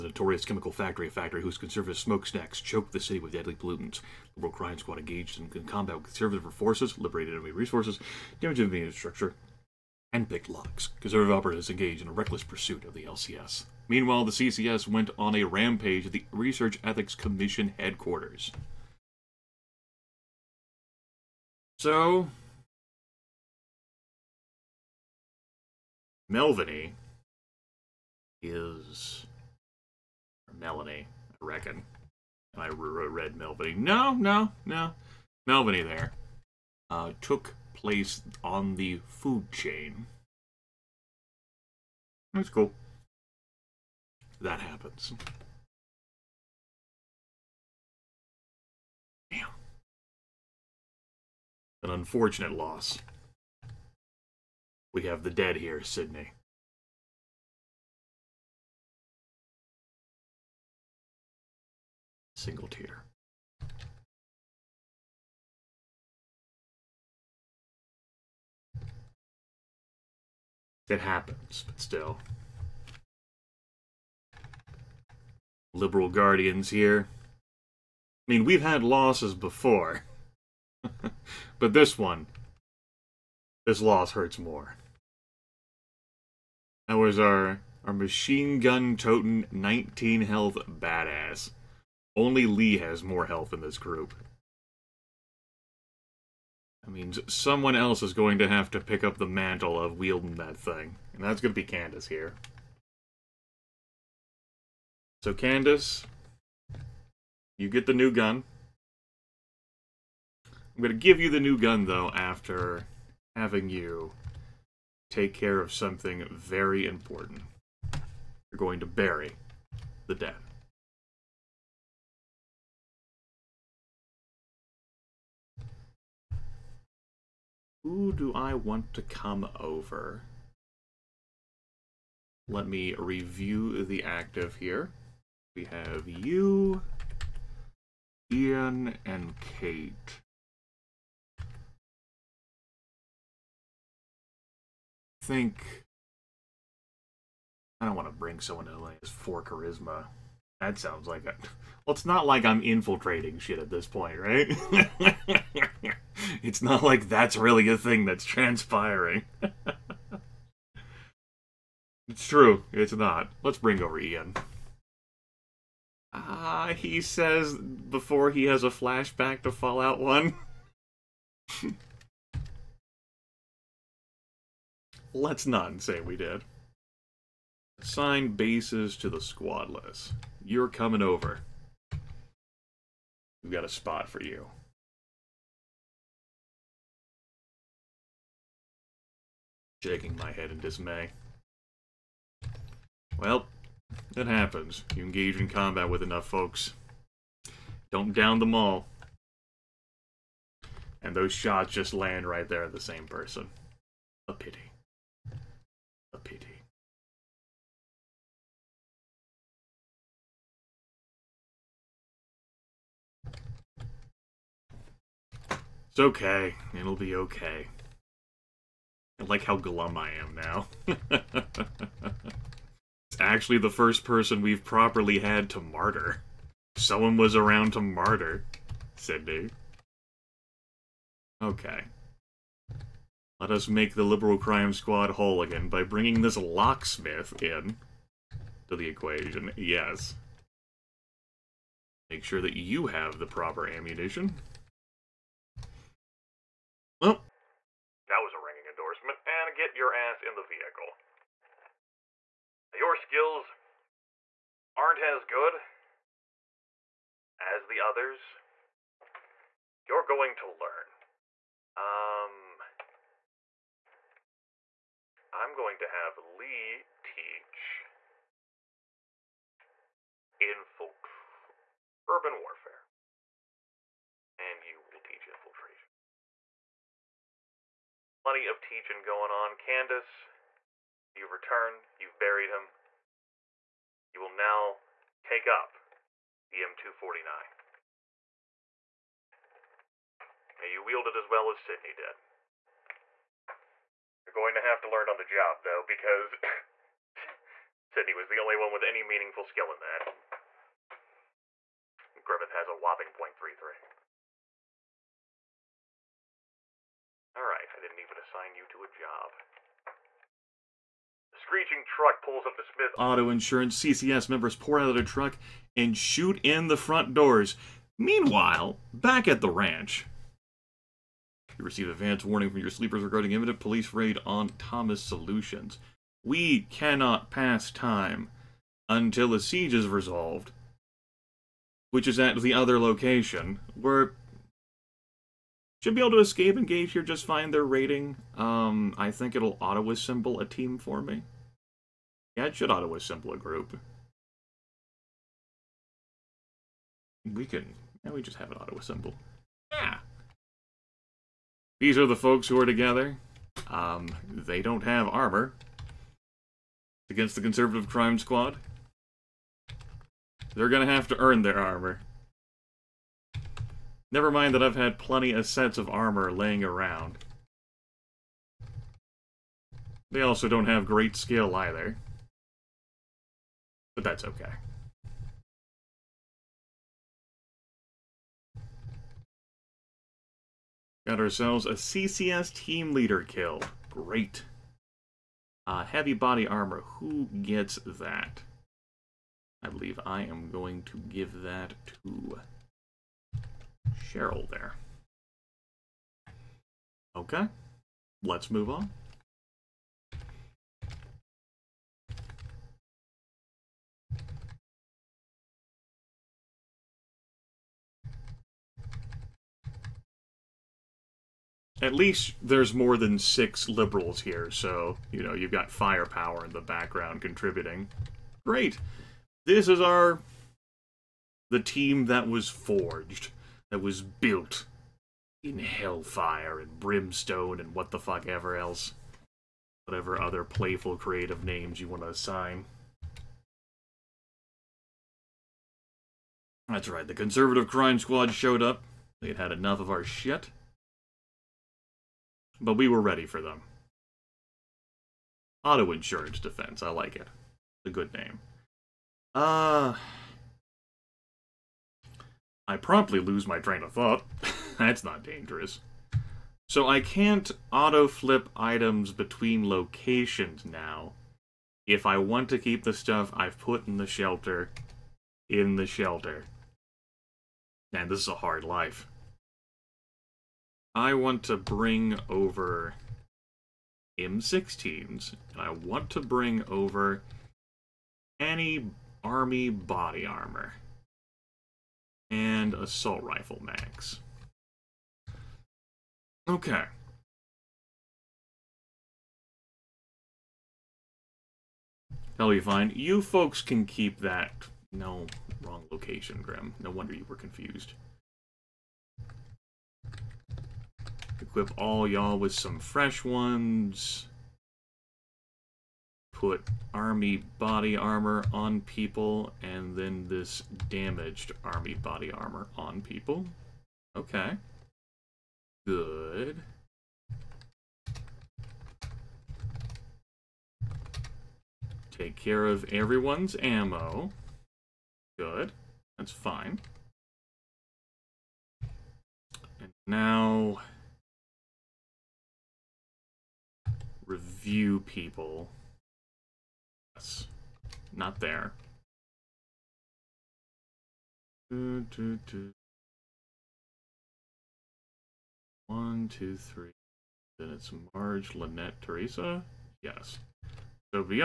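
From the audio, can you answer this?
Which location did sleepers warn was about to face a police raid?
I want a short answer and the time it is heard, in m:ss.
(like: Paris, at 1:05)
Thomas Solutions, at 5:24.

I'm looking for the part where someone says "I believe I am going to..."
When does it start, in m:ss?
6:29.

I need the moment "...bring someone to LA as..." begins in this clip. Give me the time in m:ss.
2:28.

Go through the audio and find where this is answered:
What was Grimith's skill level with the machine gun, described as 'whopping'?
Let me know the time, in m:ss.
5:03.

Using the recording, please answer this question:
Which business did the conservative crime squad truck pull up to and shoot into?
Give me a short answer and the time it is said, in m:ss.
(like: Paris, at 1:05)
Smith Auto Insurance, at 5:12.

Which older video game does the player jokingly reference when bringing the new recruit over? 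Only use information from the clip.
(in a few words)
Fallout 1.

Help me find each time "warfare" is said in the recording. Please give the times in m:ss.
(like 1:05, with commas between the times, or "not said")
4:32.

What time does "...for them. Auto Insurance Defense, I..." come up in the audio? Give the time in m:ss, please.
7:23.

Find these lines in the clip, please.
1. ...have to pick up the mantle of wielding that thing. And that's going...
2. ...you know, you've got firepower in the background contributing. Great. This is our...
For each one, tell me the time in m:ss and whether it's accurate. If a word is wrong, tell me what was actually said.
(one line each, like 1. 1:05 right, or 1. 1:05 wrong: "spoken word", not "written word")
1. 1:38 right
2. 6:55 right.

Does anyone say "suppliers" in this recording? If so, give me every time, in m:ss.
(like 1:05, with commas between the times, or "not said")
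not said.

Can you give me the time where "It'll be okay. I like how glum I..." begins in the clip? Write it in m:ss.
3:36.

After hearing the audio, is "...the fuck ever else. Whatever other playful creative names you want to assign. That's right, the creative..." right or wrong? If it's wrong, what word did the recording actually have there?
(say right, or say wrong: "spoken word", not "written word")
wrong: "conservative", not "creative".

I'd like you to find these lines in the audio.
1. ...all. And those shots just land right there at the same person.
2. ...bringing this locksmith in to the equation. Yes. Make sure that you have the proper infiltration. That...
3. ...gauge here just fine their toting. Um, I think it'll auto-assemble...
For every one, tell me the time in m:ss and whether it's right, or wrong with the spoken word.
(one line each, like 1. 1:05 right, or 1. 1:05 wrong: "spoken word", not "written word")
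1. 3:18 right
2. 3:55 wrong: "ammunition", not "infiltration"
3. 5:36 wrong: "rating", not "toting".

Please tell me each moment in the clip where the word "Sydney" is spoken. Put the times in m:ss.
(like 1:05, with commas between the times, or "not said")
0:55, 3:48, 4:51, 4:57.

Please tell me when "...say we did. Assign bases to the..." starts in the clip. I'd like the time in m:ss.
2:55.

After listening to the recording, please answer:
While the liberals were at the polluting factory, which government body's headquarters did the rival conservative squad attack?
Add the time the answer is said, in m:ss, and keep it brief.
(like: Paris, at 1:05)
Research Ethics Commission, at 0:16.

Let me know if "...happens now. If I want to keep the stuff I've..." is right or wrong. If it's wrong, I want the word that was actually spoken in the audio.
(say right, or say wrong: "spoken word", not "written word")
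wrong: "locations", not "happens".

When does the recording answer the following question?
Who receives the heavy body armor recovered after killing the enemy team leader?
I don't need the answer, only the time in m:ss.
6:34.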